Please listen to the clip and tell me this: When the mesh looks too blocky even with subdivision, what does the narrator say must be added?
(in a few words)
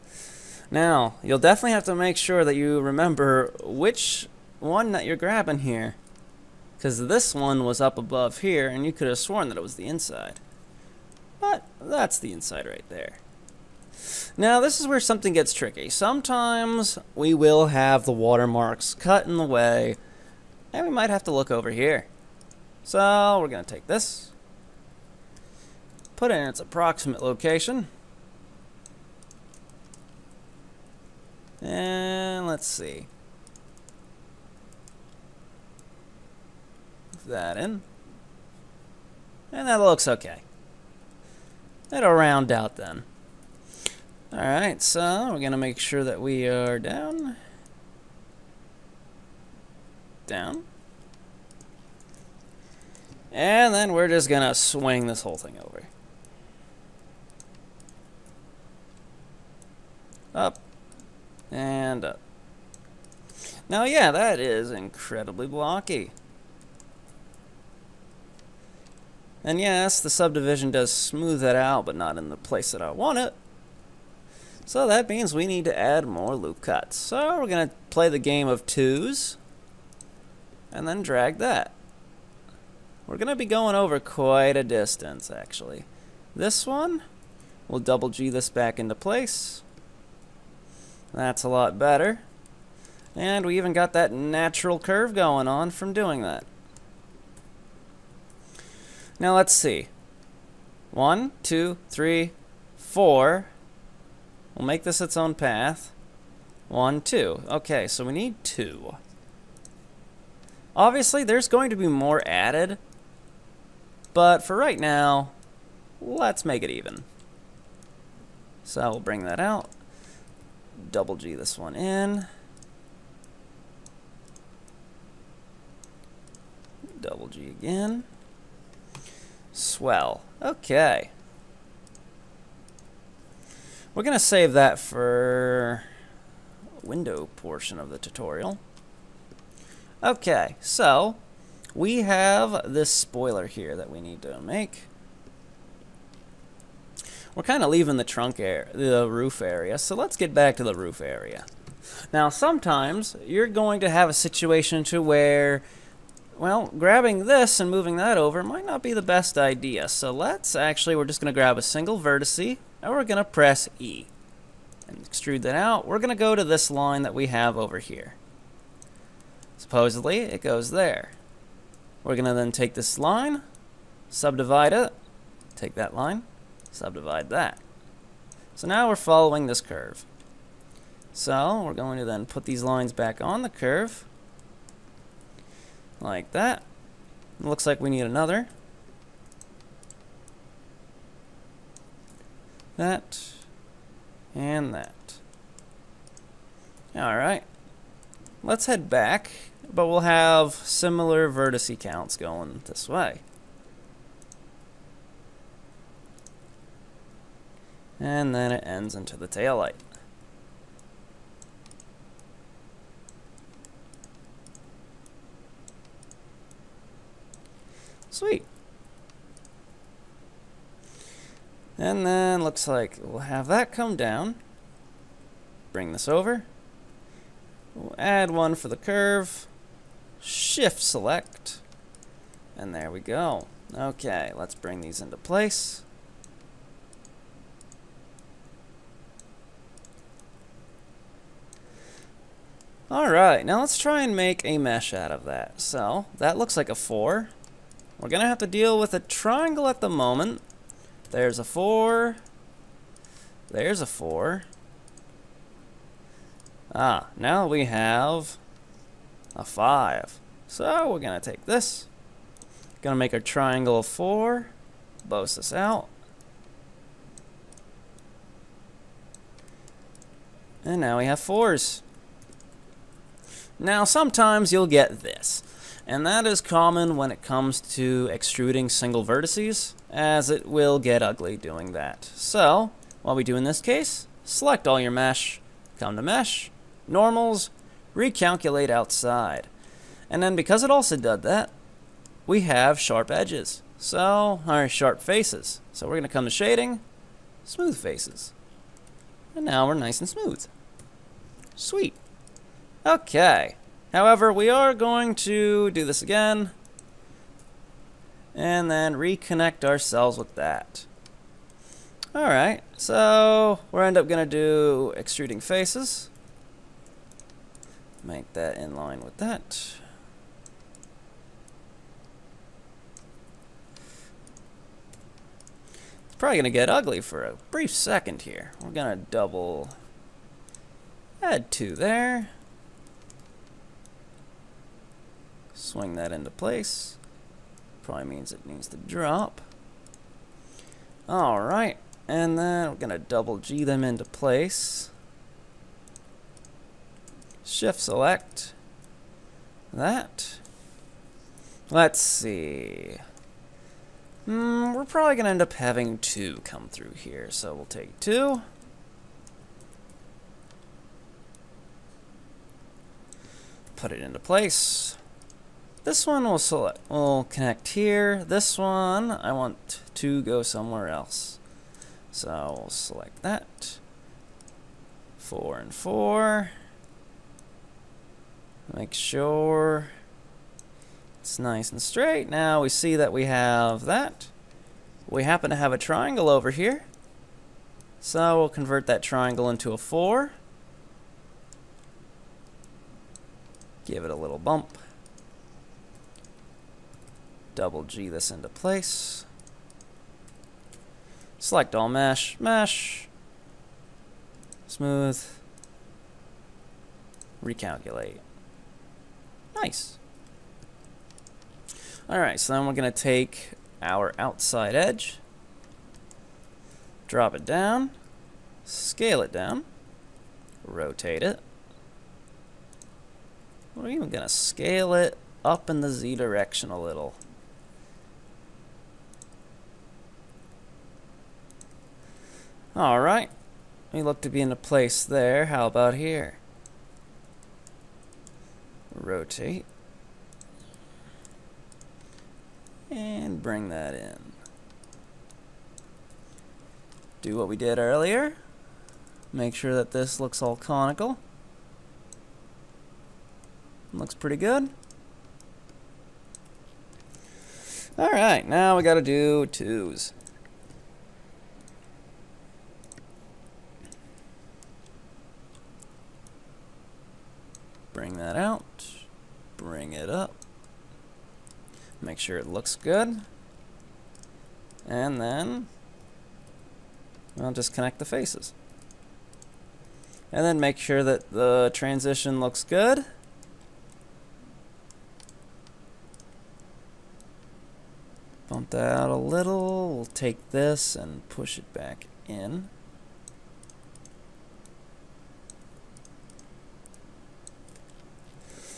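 Loop cuts.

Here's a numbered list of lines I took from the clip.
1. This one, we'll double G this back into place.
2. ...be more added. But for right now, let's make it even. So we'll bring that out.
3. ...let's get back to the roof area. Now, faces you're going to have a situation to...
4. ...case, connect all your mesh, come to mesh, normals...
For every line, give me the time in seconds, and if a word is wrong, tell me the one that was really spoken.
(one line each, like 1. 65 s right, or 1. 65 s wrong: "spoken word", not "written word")
1. 86 s right
2. 111 s right
3. 149 s wrong: "sometimes", not "faces"
4. 283 s wrong: "select", not "connect".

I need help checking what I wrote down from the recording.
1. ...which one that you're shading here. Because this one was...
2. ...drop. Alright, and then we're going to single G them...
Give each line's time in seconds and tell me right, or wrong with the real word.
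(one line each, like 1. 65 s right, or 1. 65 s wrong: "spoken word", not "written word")
1. 3 s wrong: "grabbing", not "shading"
2. 338 s wrong: "double", not "single".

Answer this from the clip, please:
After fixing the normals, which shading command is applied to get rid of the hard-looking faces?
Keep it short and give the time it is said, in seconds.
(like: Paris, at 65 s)
Smooth faces, at 297 s.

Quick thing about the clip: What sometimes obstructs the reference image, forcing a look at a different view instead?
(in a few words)
Watermarks.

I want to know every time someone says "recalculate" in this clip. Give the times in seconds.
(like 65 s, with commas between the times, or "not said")
287 s, 407 s.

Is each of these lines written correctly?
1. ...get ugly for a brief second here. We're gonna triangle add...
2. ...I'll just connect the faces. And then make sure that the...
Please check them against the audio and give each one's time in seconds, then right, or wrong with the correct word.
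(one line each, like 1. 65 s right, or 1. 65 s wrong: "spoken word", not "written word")
1. 326 s wrong: "double", not "triangle"
2. 477 s right.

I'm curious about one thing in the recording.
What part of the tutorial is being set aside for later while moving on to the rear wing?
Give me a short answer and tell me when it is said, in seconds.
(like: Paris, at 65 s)
Window portion, at 136 s.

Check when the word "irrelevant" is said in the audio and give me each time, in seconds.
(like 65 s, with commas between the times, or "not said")
not said.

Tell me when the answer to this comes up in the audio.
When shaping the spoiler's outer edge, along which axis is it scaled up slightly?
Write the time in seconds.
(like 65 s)
425 s.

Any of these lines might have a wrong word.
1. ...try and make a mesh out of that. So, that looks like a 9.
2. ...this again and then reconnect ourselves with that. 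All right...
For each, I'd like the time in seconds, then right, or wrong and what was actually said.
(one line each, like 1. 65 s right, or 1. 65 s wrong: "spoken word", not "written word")
1. 243 s wrong: "4", not "9"
2. 305 s right.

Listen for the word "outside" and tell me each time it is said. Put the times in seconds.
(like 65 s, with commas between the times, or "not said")
288 s, 414 s.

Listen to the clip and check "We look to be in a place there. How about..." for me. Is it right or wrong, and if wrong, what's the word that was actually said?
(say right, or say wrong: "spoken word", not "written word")
right.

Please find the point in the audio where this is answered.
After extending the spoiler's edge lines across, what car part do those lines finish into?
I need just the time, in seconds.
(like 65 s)
209 s.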